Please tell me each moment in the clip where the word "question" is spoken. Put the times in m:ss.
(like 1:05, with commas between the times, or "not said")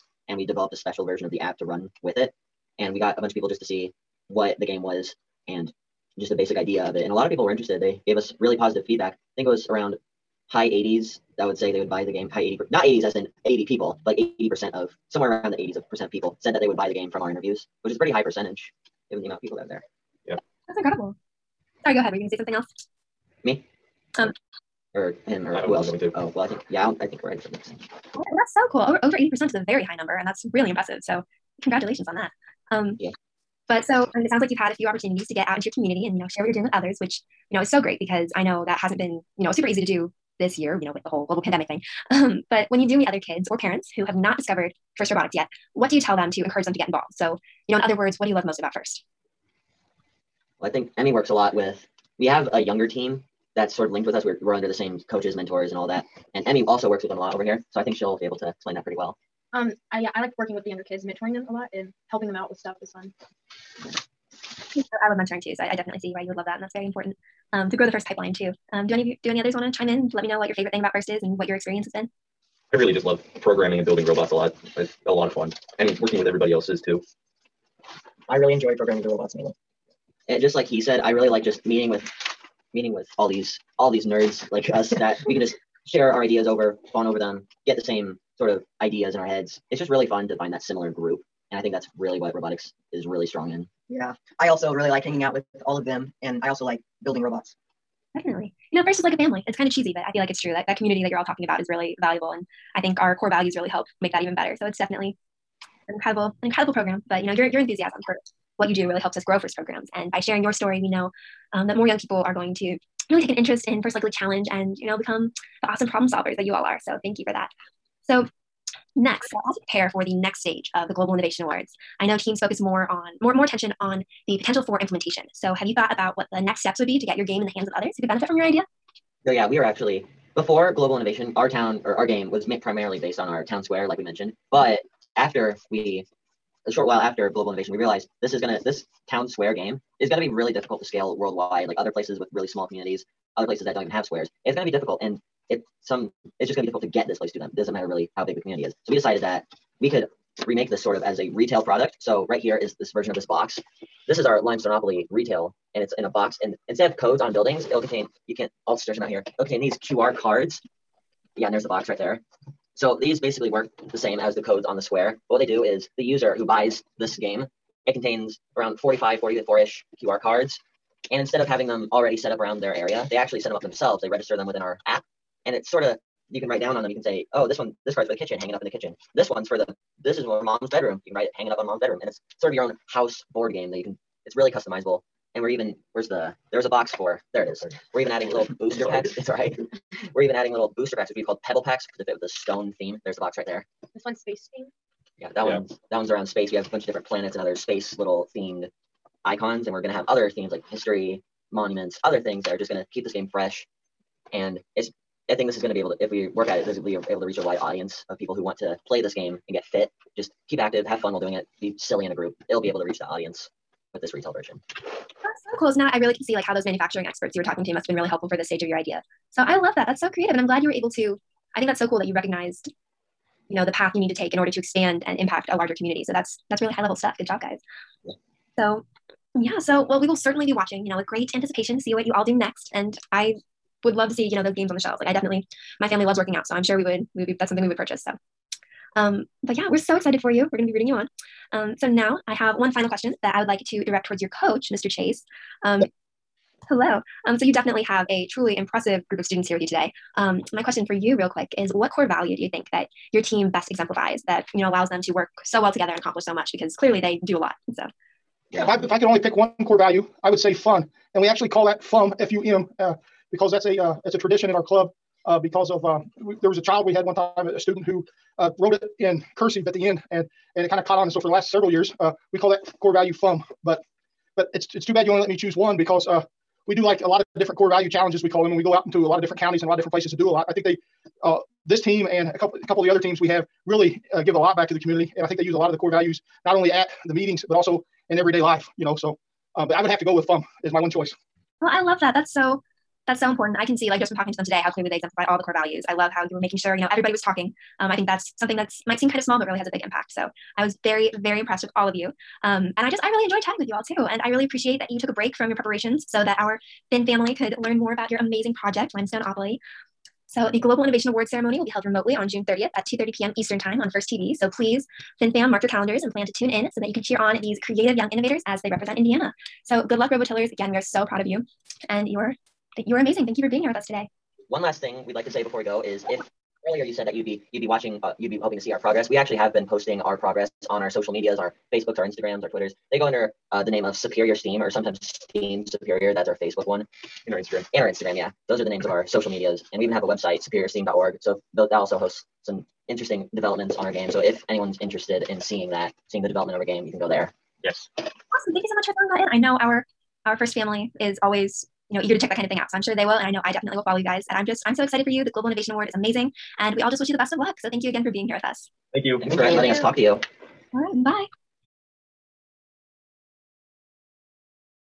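4:02, 4:10.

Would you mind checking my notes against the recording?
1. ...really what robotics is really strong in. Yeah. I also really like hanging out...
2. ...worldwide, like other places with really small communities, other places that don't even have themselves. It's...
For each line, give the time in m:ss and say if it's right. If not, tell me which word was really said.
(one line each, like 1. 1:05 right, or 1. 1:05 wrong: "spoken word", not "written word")
1. 1:31 right
2. 2:21 wrong: "squares", not "themselves".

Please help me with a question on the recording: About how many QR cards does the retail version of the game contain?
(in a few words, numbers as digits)
44.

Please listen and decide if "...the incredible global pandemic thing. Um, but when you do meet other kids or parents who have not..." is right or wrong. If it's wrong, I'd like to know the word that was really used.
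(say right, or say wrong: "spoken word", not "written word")
wrong: "whole", not "incredible".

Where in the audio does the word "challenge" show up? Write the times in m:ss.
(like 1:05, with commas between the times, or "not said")
1:54, 4:37.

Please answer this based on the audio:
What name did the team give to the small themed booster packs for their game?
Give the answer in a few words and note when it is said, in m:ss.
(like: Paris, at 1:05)
pebble packs, at 3:11.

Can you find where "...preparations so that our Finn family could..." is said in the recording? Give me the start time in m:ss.
5:05.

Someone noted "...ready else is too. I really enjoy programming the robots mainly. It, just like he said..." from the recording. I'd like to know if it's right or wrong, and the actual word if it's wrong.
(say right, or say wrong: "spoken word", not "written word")
wrong: "everybody", not "ready".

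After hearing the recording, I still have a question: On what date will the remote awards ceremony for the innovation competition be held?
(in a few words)
June 30th.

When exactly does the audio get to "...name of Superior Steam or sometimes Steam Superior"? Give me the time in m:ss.
5:33.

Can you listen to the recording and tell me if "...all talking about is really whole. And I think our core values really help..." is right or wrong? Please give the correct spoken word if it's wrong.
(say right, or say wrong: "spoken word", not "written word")
wrong: "valuable", not "whole".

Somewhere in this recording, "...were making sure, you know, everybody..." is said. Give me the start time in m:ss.
4:56.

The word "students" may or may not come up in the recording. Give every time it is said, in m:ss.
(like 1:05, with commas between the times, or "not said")
4:09, 4:27.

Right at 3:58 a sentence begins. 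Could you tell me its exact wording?
So um but yeah, we're so excited for you.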